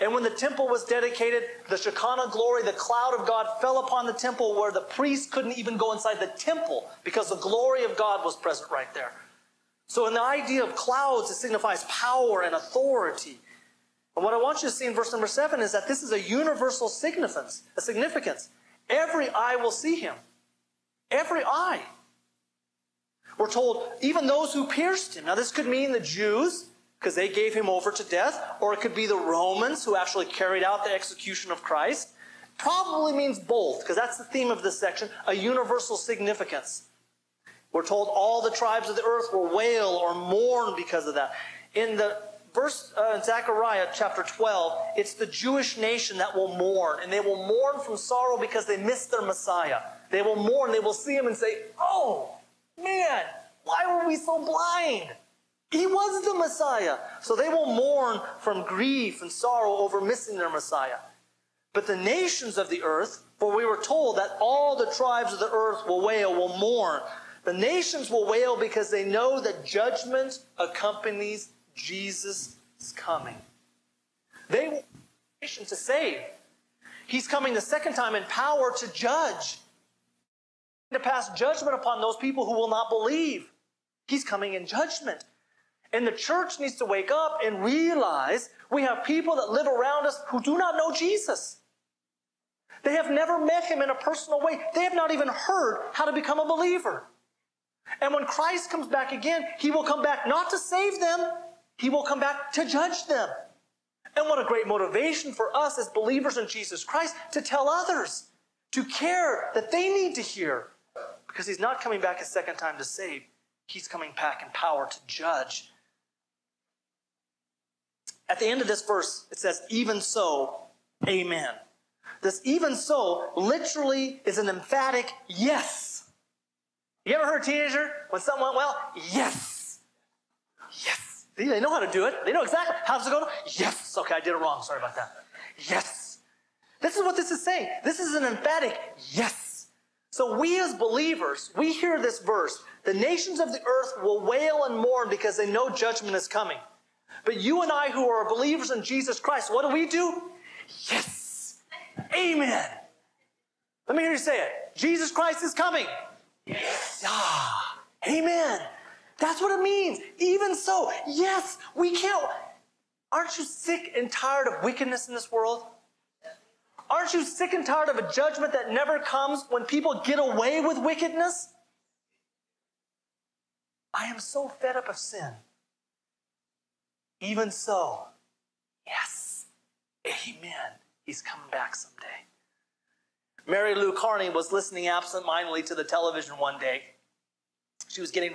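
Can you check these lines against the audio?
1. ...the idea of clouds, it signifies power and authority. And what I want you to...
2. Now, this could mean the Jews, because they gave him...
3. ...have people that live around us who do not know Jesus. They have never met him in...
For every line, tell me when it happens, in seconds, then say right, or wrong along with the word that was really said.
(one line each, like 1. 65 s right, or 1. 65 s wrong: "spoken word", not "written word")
1. 10 s right
2. 25 s right
3. 88 s right.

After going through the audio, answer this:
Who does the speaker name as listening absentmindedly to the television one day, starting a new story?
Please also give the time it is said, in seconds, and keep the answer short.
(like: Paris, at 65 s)
Mary Lou Carney, at 183 s.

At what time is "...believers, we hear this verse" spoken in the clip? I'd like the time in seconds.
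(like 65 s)
140 s.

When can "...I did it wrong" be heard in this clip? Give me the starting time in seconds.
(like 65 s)
134 s.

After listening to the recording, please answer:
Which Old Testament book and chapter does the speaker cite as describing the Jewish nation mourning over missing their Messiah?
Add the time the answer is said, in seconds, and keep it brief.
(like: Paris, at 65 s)
Zechariah chapter 12, at 43 s.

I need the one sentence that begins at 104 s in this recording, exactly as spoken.
And what a great motivation for us as believers in Jesus Christ to tell others, to care that they need to hear.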